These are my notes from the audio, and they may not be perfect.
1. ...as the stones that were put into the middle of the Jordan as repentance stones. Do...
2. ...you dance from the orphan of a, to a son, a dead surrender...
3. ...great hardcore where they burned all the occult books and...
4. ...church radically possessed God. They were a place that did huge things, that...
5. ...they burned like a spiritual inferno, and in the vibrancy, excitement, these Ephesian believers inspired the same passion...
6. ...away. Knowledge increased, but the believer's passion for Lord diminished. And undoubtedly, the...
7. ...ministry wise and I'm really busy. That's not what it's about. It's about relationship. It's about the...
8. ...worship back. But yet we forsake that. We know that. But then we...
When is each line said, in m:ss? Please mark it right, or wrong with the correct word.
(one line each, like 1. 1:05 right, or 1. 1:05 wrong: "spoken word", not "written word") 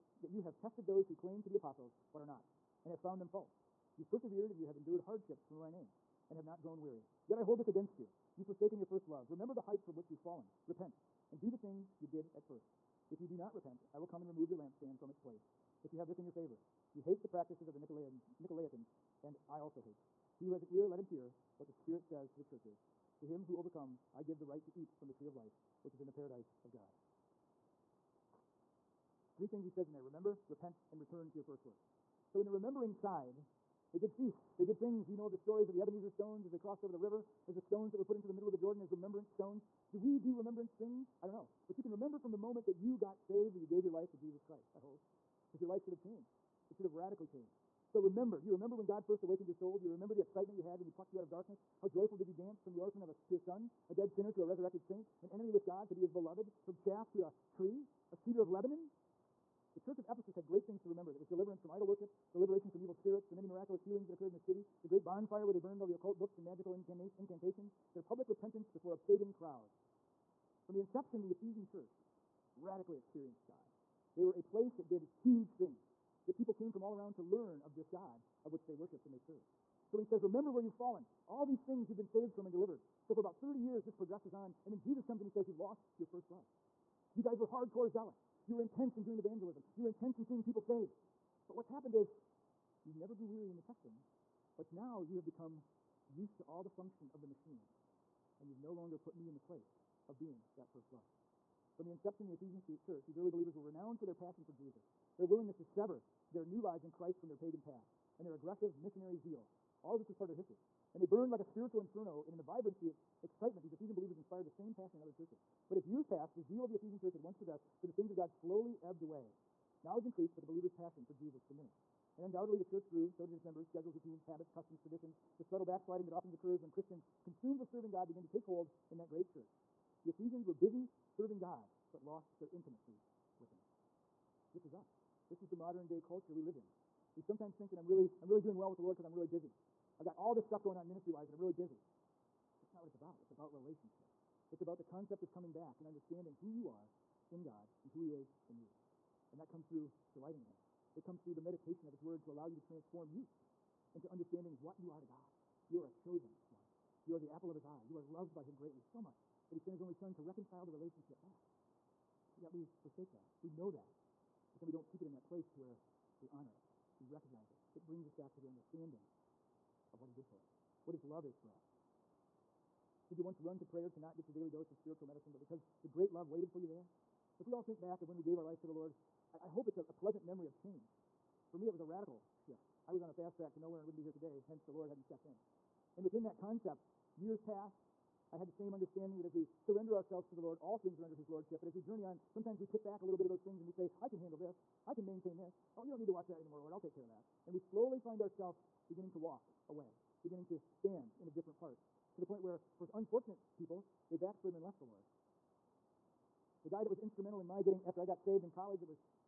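1. 0:37 wrong: "remembrance", not "repentance"
2. 0:52 wrong: "sinner", not "surrender"
3. 1:04 wrong: "bonfire", not "hardcore"
4. 1:11 wrong: "experienced", not "possessed"
5. 1:50 right
6. 1:59 wrong: "Jesus", not "Lord"
7. 2:20 right
8. 2:40 wrong: "relationship", not "worship".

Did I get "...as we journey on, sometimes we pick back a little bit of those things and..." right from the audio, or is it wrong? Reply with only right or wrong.
right.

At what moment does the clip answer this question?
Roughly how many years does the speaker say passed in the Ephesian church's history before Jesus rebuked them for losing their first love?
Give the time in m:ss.
1:23.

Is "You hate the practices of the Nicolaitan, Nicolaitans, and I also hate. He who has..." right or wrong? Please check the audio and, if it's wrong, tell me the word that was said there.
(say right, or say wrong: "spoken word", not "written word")
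right.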